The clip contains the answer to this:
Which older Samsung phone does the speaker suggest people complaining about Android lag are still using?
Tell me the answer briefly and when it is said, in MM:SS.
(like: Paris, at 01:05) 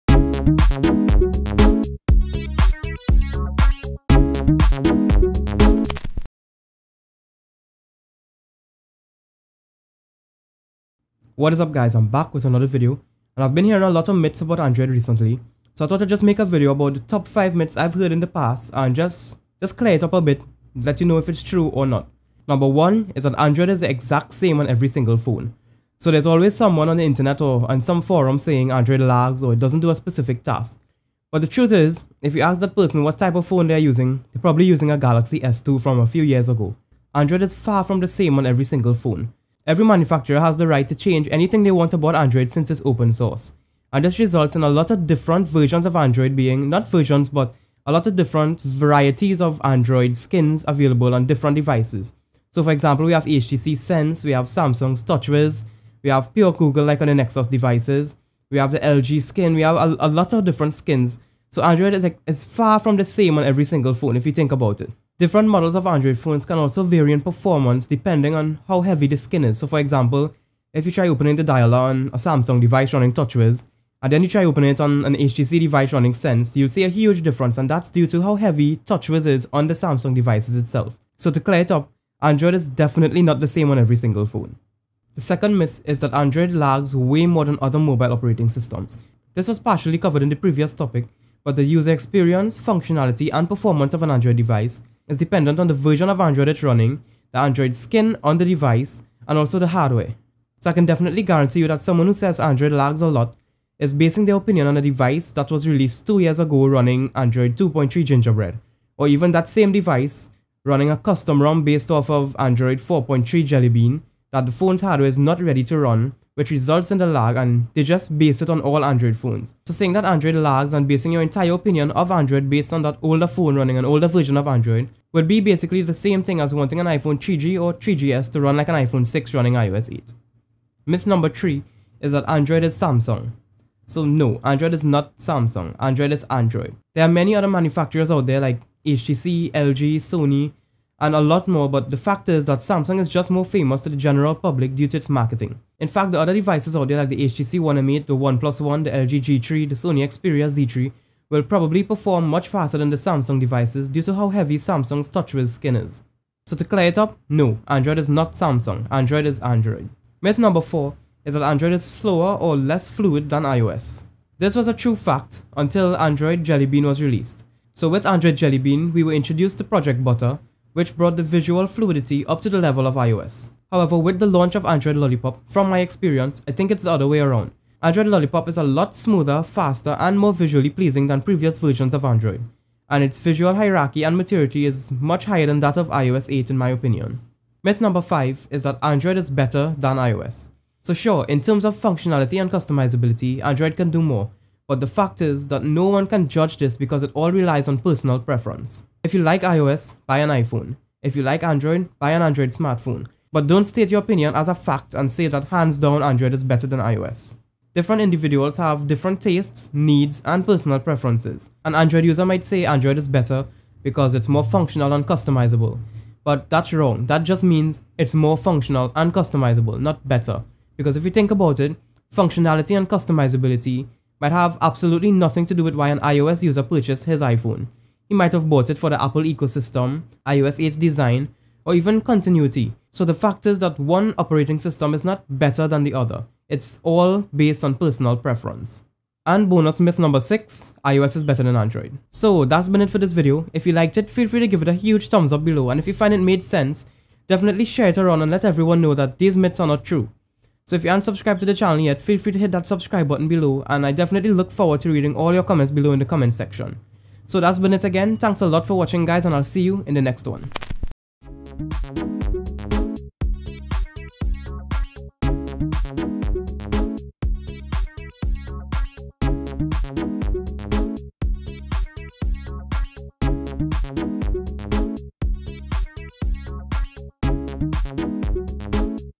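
Galaxy S2, at 00:34.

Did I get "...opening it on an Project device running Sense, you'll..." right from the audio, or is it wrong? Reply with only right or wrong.
wrong.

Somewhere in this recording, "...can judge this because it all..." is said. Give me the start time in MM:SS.
03:16.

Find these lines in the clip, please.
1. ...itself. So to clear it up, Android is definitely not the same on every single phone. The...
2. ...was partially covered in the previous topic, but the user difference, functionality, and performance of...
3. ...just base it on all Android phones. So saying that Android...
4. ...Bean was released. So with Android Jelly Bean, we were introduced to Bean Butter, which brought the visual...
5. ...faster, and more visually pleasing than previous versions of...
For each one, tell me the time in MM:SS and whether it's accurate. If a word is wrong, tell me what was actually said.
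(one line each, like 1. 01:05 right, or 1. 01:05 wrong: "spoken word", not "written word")
1. 01:20 right
2. 01:29 wrong: "experience", not "difference"
3. 01:57 right
4. 02:46 wrong: "Project", not "Bean"
5. 02:59 right.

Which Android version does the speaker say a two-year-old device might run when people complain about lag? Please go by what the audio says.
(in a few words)
Android 2.3 Gingerbread.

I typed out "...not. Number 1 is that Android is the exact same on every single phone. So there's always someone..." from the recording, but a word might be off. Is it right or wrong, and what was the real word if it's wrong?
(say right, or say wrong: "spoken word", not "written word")
right.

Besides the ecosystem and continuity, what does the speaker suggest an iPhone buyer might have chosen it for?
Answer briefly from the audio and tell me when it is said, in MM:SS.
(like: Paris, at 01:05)
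iOS 8's design, at 03:50.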